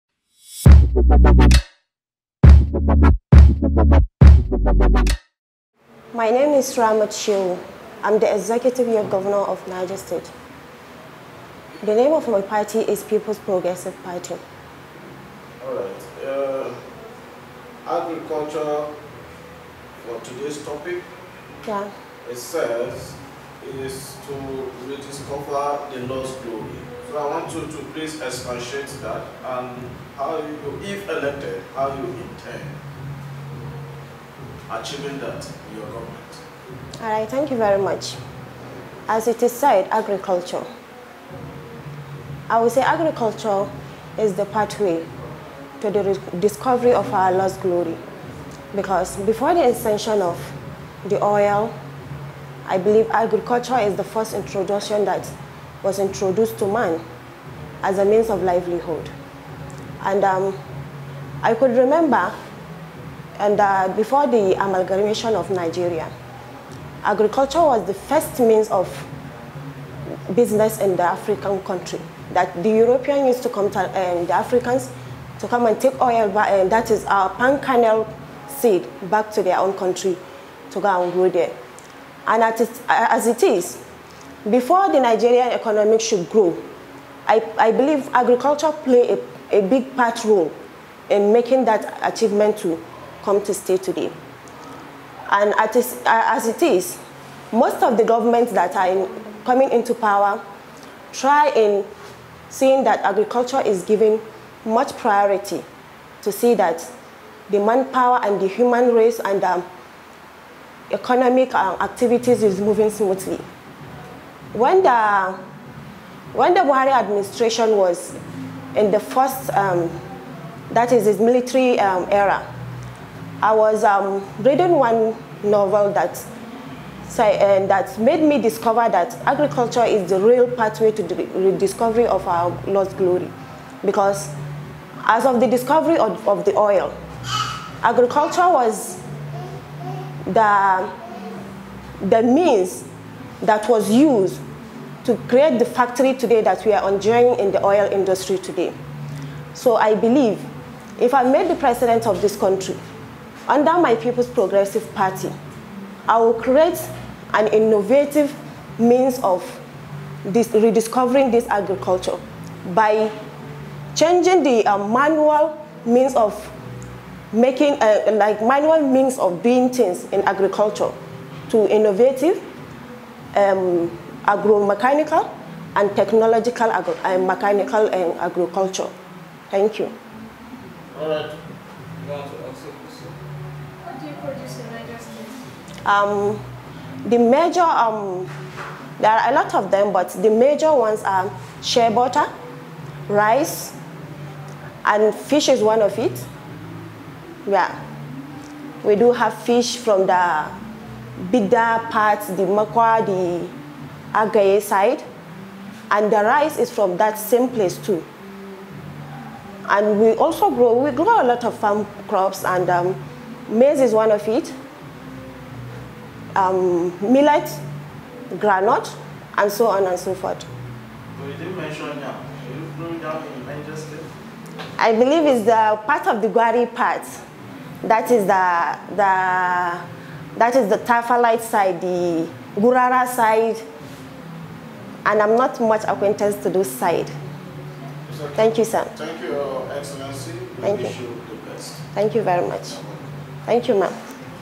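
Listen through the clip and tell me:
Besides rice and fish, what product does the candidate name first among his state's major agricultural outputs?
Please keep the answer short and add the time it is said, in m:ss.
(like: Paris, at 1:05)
Shea butter, at 3:11.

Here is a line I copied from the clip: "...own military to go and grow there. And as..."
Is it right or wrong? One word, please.
wrong.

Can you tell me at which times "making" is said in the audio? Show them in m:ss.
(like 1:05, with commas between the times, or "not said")
1:31, 2:47.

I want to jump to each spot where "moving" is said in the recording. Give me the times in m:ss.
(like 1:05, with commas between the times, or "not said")
1:52.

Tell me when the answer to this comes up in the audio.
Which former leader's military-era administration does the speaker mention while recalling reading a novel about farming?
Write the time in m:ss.
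1:56.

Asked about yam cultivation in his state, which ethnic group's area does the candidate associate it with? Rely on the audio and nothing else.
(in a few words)
Gwari.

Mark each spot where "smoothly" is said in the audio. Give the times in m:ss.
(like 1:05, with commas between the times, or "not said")
1:52.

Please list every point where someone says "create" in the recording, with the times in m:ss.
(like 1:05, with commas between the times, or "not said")
2:25, 2:36.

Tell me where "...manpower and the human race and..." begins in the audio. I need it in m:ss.
1:47.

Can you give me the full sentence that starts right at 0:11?
The name of my party is People's Progressive Party.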